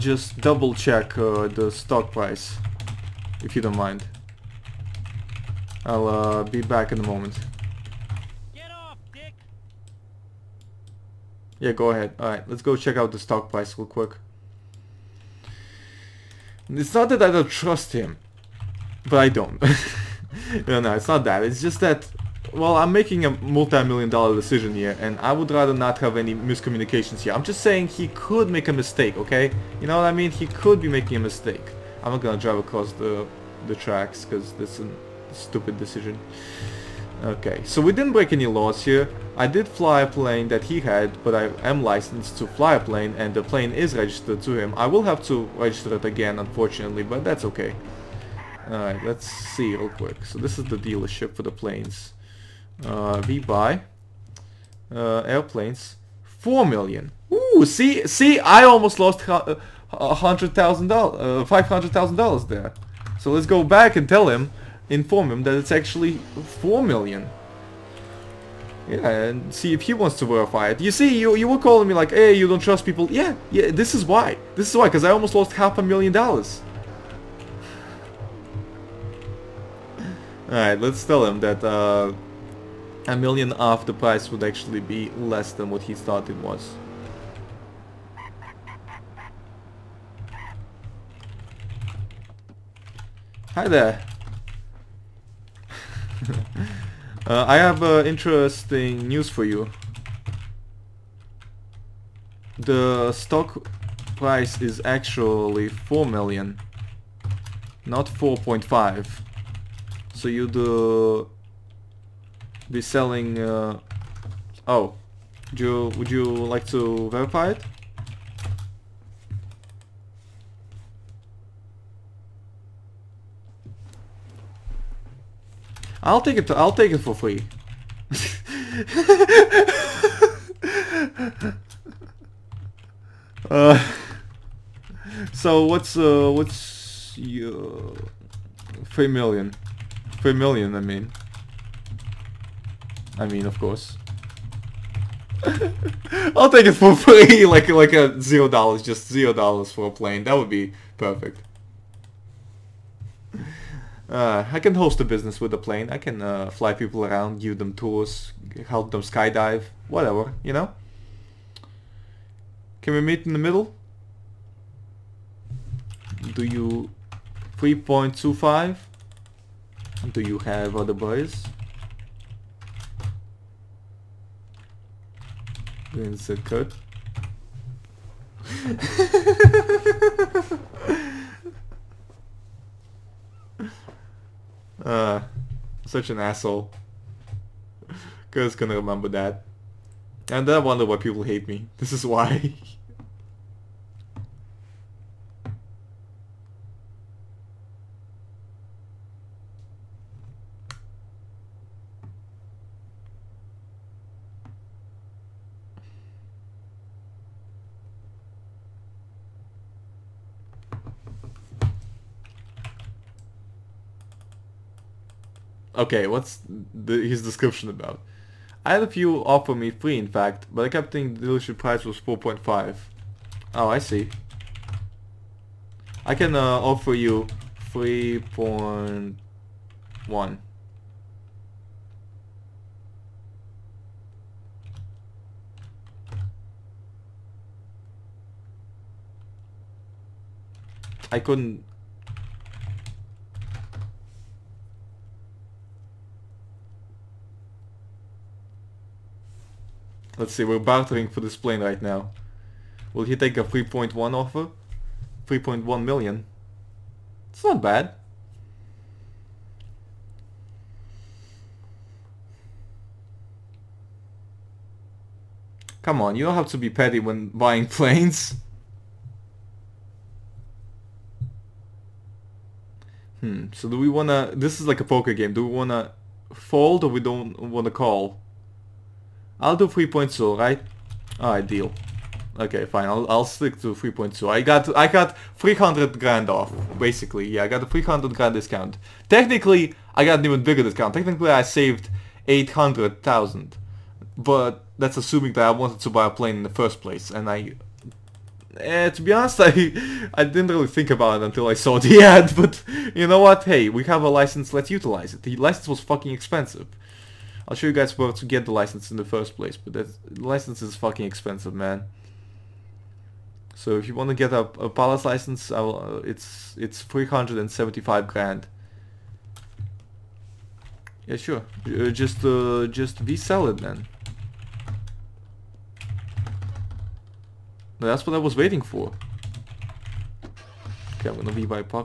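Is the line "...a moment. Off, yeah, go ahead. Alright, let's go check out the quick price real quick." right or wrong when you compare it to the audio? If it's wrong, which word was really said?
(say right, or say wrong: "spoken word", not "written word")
wrong: "stock", not "quick".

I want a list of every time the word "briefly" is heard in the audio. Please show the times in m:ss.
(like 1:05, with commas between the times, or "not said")
not said.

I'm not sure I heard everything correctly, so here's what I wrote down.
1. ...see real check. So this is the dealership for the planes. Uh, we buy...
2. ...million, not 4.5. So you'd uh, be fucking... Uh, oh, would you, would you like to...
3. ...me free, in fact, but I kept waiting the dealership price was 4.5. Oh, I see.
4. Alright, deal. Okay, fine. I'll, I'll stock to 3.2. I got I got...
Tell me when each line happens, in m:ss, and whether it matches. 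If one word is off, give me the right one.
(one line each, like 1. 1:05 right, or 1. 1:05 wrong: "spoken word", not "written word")
1. 0:49 wrong: "quick", not "check"
2. 1:46 wrong: "selling", not "fucking"
3. 3:39 wrong: "thinking", not "waiting"
4. 4:41 wrong: "stick", not "stock".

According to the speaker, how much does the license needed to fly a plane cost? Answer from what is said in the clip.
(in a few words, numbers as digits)
375 grand.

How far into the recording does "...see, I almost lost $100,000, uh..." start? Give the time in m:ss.
0:58.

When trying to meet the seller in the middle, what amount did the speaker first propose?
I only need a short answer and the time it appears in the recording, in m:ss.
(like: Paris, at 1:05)
3.25, at 2:47.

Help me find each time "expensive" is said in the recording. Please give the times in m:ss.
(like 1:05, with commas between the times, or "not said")
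5:06, 5:11.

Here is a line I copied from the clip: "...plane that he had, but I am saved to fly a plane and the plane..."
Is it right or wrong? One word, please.
wrong.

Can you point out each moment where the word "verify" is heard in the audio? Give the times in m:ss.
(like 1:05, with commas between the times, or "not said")
1:10, 1:57.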